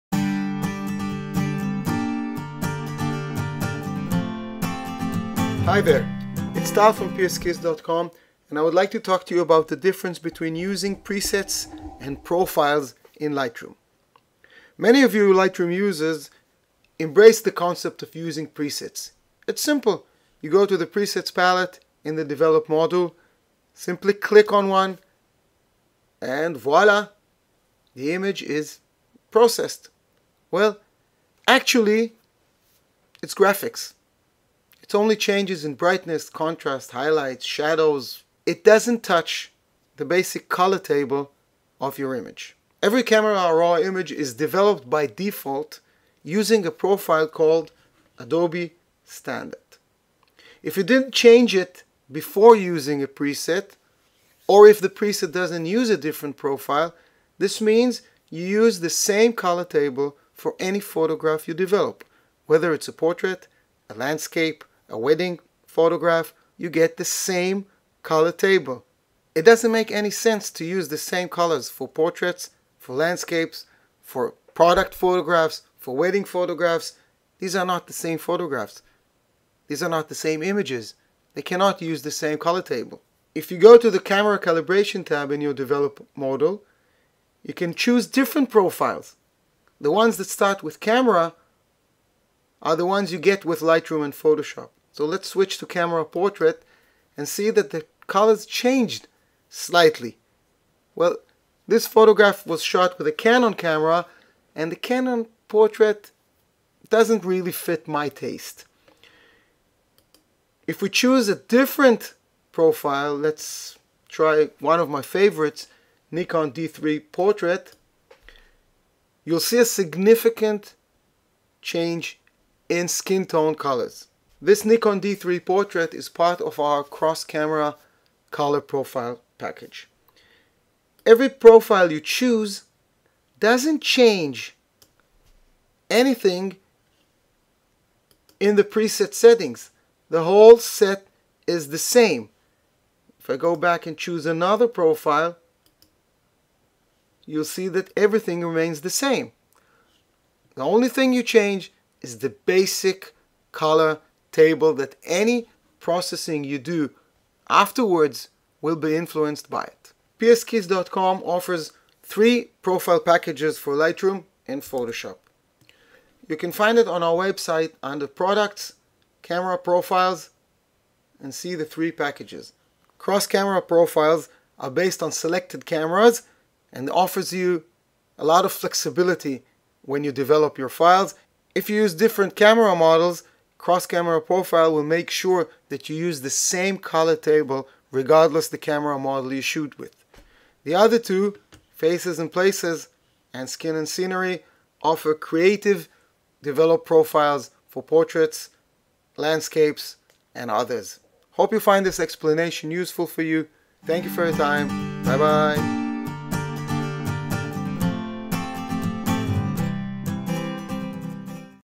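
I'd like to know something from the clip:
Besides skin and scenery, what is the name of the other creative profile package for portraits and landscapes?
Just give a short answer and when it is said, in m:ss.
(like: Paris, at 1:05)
Faces and places, at 3:11.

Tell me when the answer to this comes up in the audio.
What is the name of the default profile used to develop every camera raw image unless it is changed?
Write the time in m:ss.
0:48.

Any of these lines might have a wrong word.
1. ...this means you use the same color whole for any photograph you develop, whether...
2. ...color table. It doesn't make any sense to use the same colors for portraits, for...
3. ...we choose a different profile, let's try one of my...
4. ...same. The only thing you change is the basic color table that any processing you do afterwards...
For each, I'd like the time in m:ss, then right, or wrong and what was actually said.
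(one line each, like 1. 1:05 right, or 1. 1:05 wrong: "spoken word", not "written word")
1. 0:57 wrong: "table", not "whole"
2. 1:08 right
3. 1:50 right
4. 2:28 right.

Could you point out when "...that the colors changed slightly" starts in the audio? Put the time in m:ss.
1:37.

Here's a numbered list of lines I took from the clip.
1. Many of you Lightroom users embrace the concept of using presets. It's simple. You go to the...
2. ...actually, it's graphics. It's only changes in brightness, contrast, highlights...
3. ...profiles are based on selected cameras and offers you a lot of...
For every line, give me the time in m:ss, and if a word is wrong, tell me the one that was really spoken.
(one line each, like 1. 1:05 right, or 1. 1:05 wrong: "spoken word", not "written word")
1. 0:14 right
2. 0:31 right
3. 2:53 right.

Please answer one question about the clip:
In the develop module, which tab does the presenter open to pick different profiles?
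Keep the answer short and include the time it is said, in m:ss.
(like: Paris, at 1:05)
Camera calibration, at 1:24.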